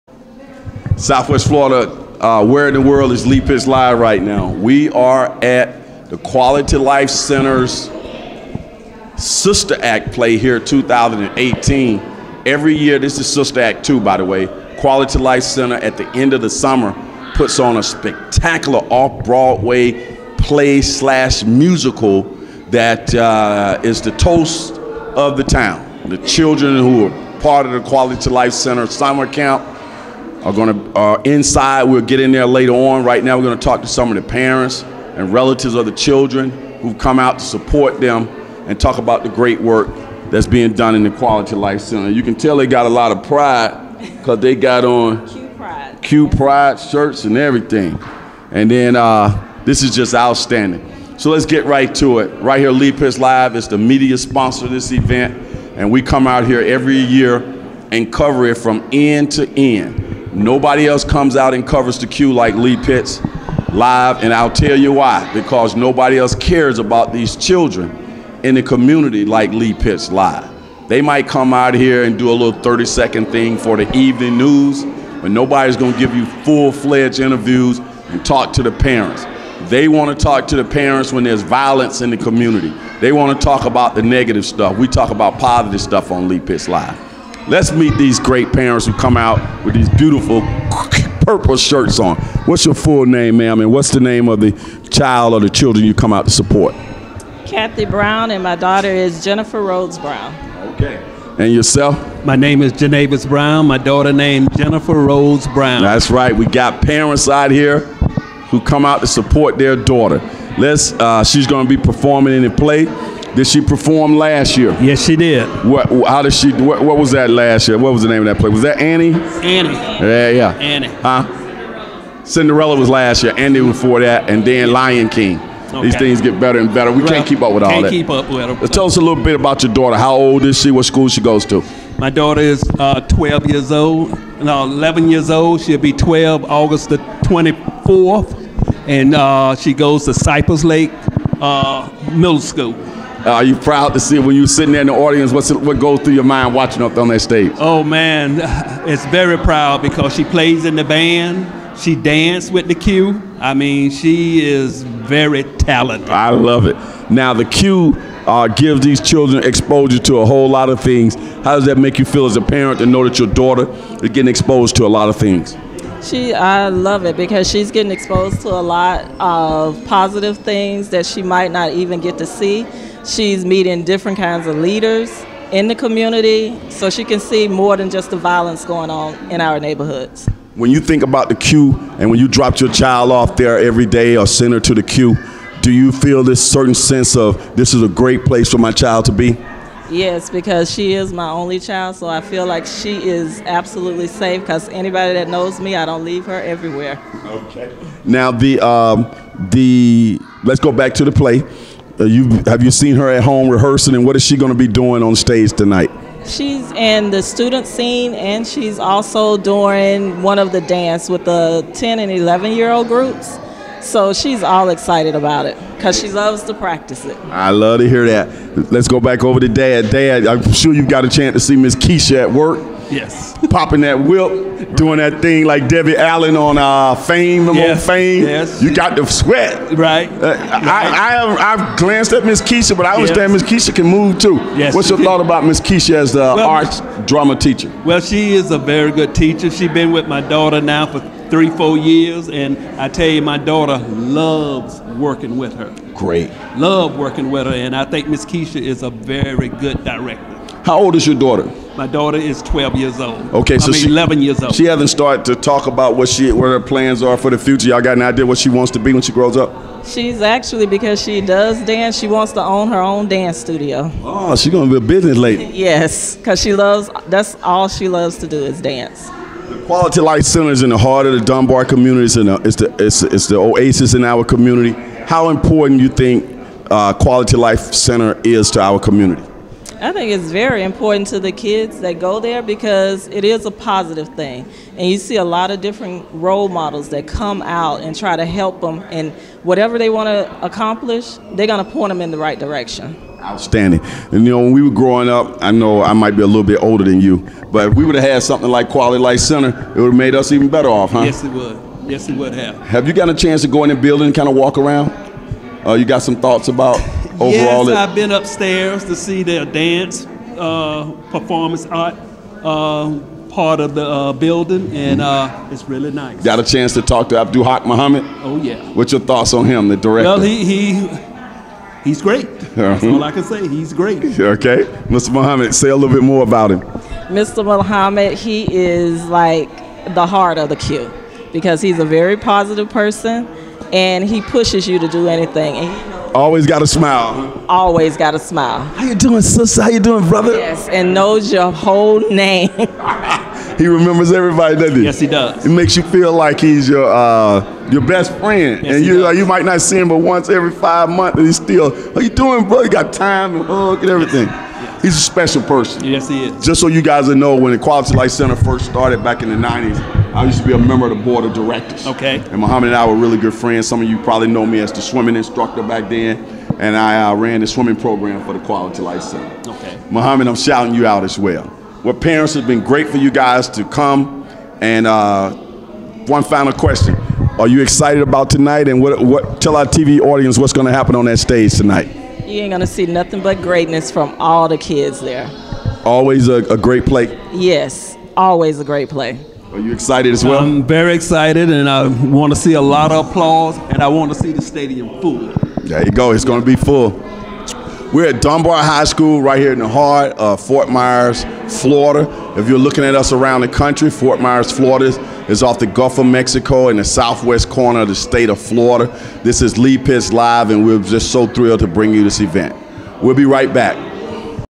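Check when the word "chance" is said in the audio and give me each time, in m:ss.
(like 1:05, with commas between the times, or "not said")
3:41, 5:03, 5:16.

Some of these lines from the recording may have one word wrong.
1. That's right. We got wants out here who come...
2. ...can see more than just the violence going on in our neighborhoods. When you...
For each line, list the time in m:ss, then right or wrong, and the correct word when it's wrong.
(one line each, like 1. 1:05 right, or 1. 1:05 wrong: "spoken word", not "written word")
1. 1:45 wrong: "parents", not "wants"
2. 2:57 right.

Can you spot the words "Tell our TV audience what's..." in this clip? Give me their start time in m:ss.
6:19.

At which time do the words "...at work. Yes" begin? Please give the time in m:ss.
3:42.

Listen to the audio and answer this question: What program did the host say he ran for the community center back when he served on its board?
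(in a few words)
Swimming program.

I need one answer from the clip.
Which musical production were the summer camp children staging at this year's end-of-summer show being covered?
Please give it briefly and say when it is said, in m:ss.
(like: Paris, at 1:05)
Sister Act 2, at 0:13.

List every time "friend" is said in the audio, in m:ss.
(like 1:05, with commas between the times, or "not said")
5:48, 6:03.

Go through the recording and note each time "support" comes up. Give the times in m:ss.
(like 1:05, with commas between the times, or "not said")
0:37, 1:36, 1:49.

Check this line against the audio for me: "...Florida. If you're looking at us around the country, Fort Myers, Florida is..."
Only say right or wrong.
right.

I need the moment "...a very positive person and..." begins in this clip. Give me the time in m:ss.
5:31.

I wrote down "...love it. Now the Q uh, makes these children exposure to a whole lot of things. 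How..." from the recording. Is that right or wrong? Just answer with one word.
wrong.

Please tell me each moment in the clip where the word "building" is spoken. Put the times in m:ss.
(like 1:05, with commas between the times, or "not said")
5:03, 5:14.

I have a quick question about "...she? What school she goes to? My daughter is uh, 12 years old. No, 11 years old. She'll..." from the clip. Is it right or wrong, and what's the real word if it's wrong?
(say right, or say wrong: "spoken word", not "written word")
right.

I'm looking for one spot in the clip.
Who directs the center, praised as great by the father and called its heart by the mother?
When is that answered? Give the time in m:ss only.
5:17.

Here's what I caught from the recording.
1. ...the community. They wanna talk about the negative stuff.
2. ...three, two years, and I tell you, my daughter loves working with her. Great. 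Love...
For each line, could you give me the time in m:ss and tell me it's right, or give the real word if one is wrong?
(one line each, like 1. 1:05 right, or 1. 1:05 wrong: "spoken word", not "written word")
1. 1:22 right
2. 4:01 wrong: "four", not "two".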